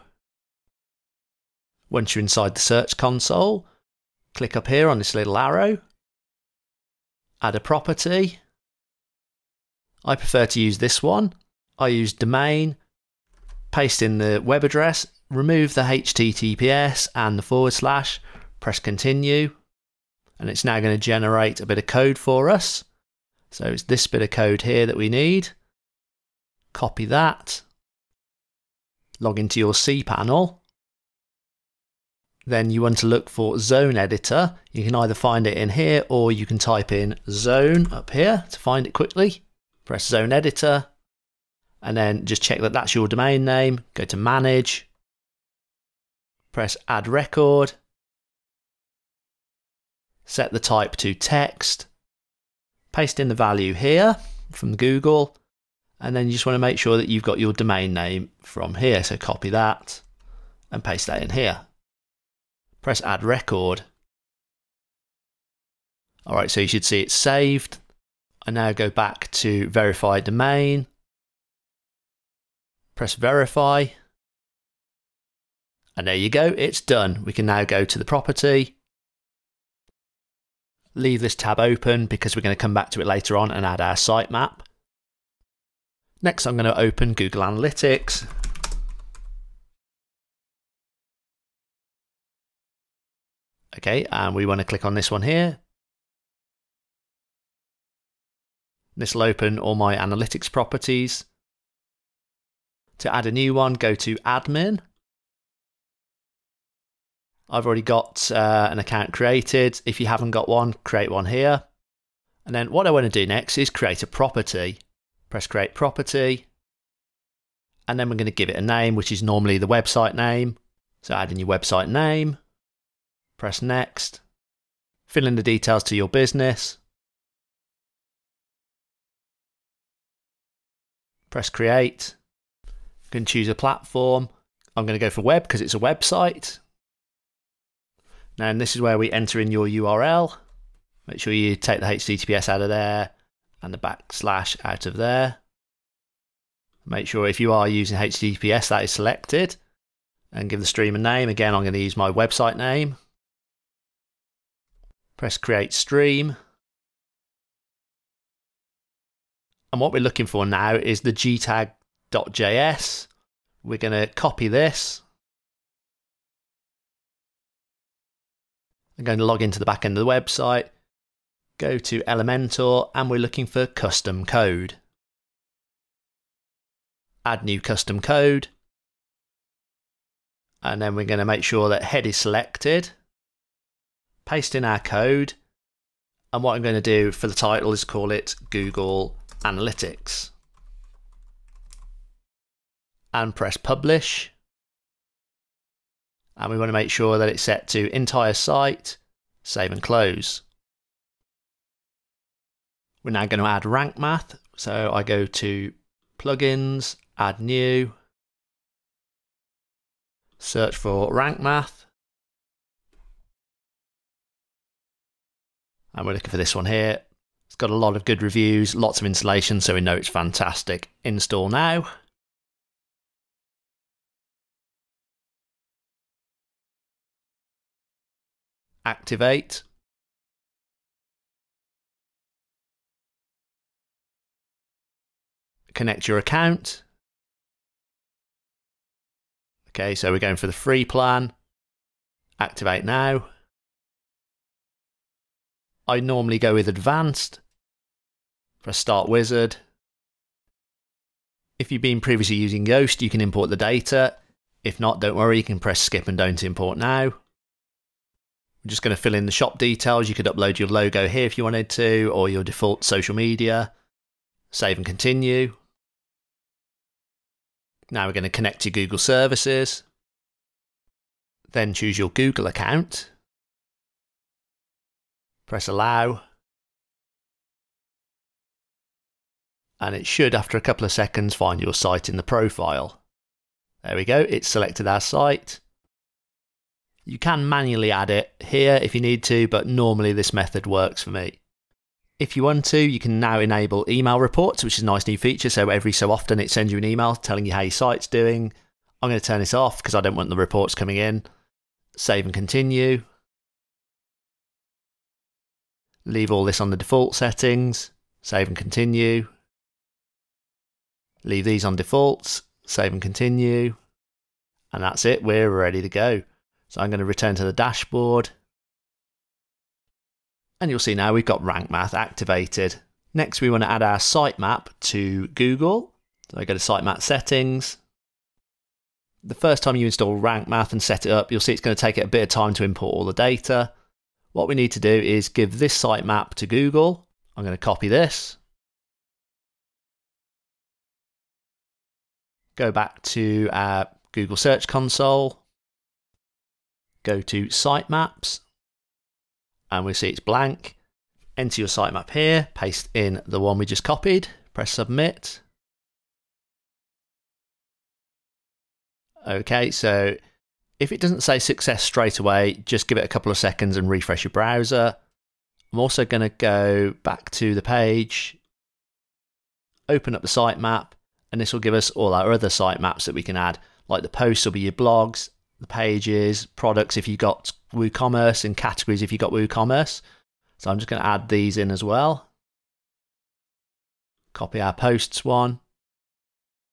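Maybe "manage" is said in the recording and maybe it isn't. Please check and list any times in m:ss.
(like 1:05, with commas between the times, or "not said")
0:44.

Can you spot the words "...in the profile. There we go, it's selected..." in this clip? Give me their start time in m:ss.
4:42.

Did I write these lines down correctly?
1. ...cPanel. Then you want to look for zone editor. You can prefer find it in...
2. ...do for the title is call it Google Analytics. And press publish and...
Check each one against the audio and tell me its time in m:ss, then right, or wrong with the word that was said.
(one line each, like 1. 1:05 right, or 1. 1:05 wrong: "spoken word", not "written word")
1. 0:29 wrong: "either", not "prefer"
2. 3:06 right.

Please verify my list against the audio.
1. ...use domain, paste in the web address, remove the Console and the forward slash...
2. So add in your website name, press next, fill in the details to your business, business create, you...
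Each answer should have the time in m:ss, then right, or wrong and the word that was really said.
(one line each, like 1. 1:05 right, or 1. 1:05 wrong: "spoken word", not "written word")
1. 0:11 wrong: "HTTPS", not "Console"
2. 2:01 wrong: "press", not "business".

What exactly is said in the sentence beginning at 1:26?
Next, I'm going to open Google Analytics.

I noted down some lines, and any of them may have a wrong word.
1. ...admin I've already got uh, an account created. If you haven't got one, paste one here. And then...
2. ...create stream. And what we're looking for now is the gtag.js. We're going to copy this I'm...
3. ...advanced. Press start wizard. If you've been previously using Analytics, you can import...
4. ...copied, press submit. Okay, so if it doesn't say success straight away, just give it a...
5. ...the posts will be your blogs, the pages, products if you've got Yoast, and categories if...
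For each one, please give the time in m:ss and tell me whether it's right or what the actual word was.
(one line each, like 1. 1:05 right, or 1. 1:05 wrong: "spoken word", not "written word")
1. 1:44 wrong: "create", not "paste"
2. 2:35 right
3. 4:06 wrong: "Yoast", not "Analytics"
4. 5:53 right
5. 6:14 wrong: "WooCommerce", not "Yoast".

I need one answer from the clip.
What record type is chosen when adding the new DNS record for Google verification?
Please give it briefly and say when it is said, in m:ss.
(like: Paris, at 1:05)
Text, at 0:50.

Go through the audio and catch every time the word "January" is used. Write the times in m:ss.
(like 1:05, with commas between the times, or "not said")
not said.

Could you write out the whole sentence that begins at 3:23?
We're now going to add rank math.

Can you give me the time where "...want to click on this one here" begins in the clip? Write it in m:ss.
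1:34.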